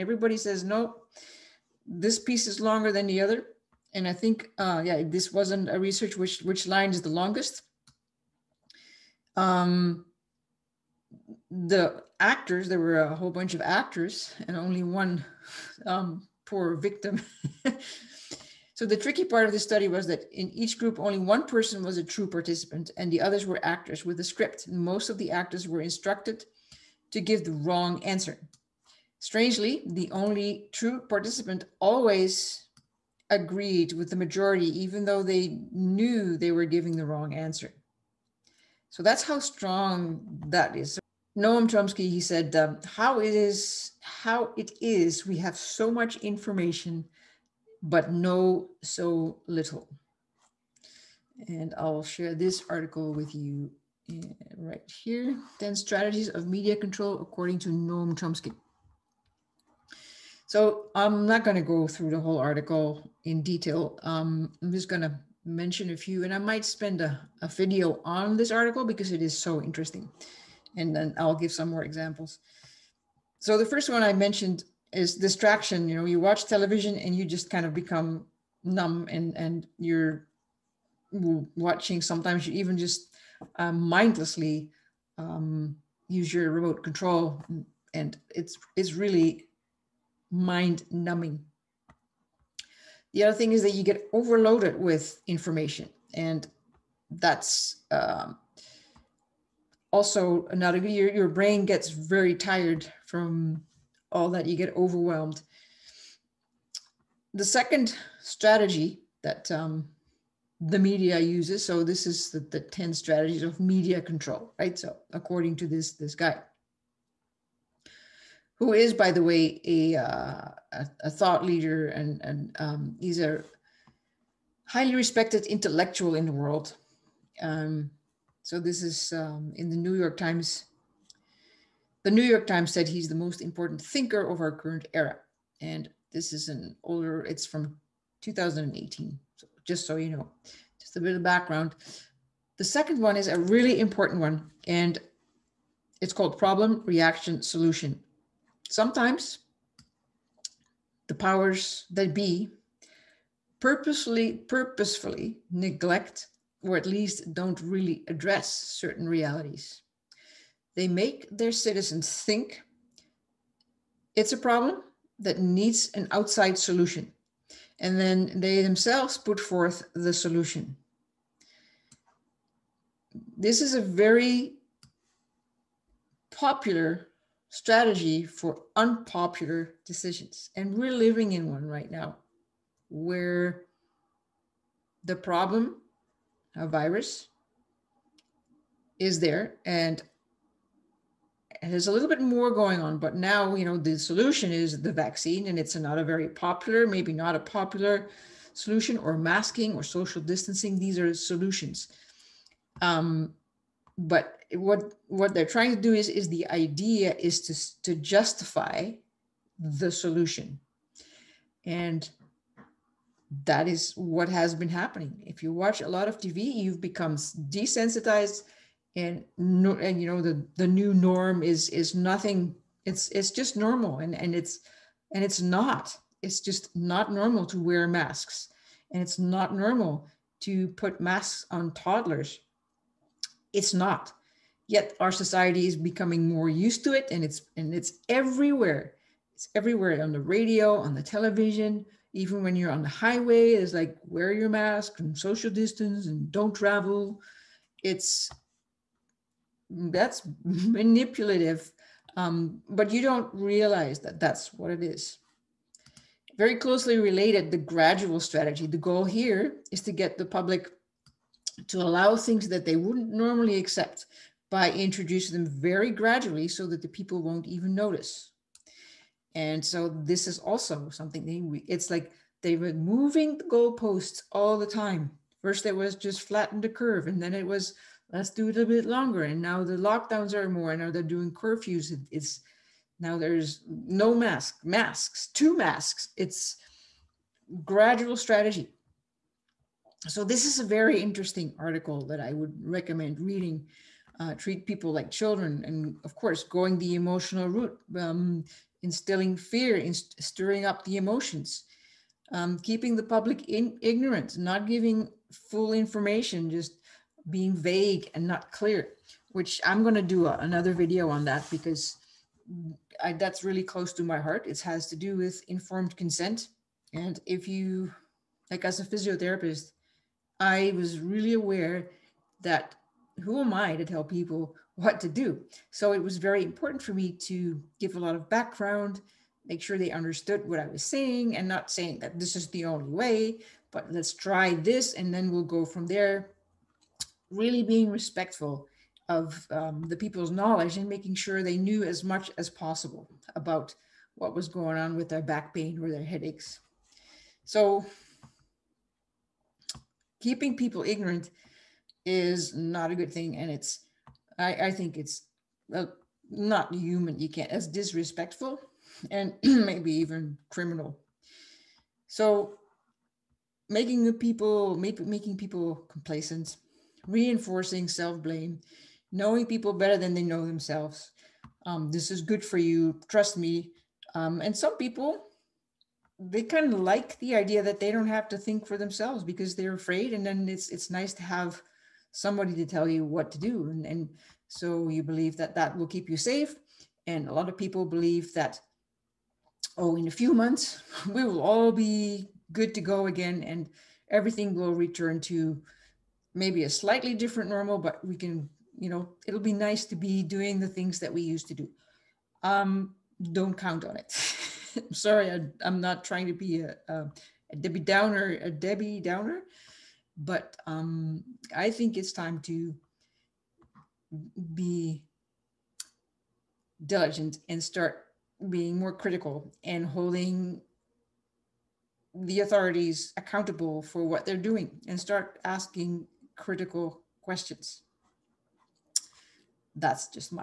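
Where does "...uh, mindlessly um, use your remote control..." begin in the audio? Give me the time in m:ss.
1:23.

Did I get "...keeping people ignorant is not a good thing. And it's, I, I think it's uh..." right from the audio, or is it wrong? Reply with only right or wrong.
right.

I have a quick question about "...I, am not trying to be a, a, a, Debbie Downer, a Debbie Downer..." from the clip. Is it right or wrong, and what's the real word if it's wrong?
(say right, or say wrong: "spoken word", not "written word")
right.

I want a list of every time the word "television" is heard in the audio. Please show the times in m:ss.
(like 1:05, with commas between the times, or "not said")
1:16, 4:01.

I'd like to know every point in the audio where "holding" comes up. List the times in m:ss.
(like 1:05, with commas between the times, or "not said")
6:59.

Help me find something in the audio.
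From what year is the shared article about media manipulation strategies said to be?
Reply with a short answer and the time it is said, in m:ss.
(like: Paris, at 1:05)
2018, at 2:18.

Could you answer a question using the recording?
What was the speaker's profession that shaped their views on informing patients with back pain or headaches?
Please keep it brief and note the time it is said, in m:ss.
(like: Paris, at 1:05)
physiotherapist, at 5:18.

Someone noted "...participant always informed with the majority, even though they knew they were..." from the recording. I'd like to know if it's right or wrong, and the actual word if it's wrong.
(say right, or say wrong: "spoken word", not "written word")
wrong: "agreed", not "informed".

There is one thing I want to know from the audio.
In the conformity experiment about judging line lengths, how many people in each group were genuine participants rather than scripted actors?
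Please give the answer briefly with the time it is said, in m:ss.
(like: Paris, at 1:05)
1, at 0:20.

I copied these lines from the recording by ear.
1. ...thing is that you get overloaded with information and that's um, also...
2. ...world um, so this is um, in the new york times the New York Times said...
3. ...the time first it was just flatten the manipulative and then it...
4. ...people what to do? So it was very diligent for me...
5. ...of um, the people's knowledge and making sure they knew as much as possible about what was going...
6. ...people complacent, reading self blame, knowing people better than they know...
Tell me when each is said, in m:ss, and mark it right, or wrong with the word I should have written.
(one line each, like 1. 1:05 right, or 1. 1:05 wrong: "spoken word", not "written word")
1. 1:33 right
2. 2:06 right
3. 4:34 wrong: "curve", not "manipulative"
4. 5:24 wrong: "important", not "diligent"
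5. 5:39 right
6. 6:05 wrong: "reinforcing", not "reading".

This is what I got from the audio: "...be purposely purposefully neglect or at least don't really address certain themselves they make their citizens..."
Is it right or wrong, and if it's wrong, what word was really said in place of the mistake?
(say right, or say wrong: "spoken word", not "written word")
wrong: "realities", not "themselves".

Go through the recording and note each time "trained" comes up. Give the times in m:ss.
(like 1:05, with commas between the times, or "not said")
not said.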